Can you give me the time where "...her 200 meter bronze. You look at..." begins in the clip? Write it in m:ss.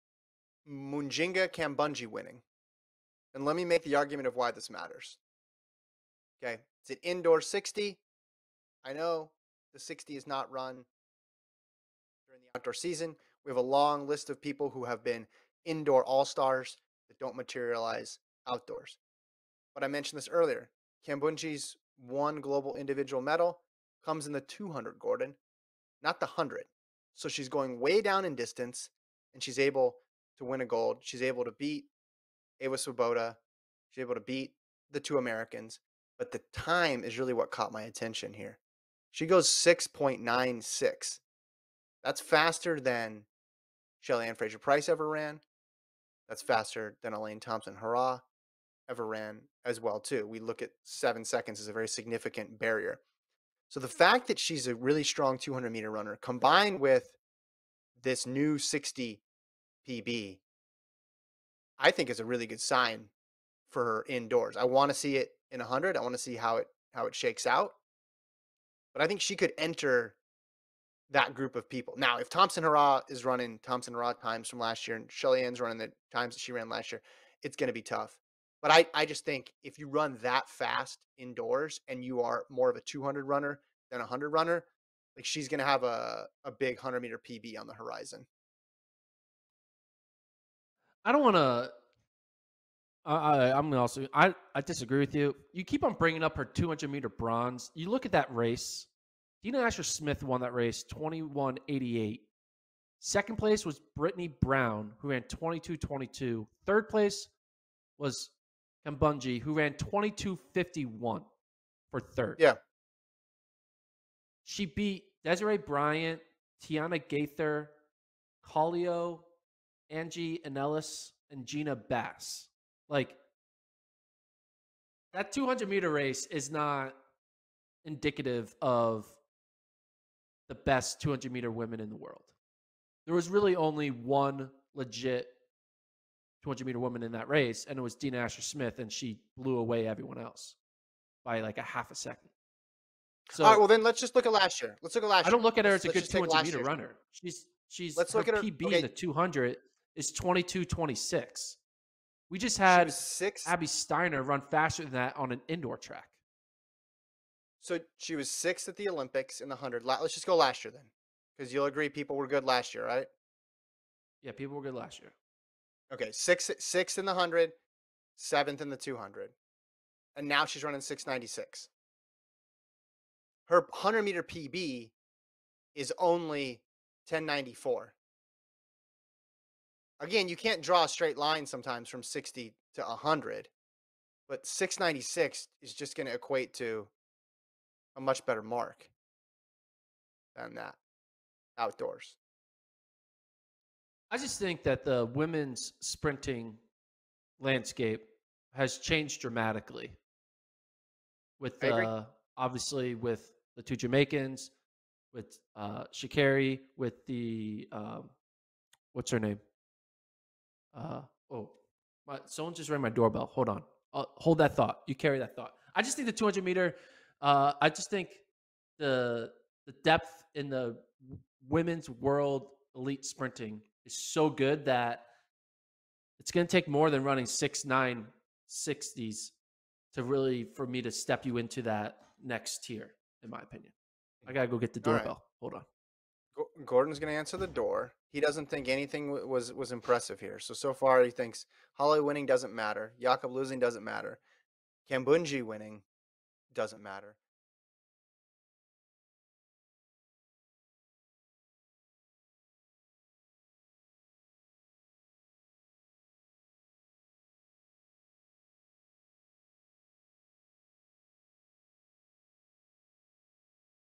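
1:36.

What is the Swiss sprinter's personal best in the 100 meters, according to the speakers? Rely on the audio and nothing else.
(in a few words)
10.94.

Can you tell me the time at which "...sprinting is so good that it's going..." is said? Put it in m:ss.
3:43.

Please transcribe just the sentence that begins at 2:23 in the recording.
So, All right, well then let's just look at last year.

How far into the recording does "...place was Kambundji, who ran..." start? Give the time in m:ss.
1:46.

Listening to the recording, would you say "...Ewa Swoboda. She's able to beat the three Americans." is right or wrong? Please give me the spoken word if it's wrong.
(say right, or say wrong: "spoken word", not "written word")
wrong: "two", not "three".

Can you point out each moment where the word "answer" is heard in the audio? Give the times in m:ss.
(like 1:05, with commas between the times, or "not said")
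3:57.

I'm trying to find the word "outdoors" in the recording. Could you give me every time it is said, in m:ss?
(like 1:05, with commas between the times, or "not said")
0:12, 0:18, 3:11.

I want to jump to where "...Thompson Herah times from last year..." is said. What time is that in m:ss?
1:13.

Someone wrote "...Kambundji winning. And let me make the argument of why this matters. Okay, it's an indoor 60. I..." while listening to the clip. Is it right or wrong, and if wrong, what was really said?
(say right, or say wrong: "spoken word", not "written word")
right.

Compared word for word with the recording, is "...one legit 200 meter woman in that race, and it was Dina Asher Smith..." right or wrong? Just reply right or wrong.
right.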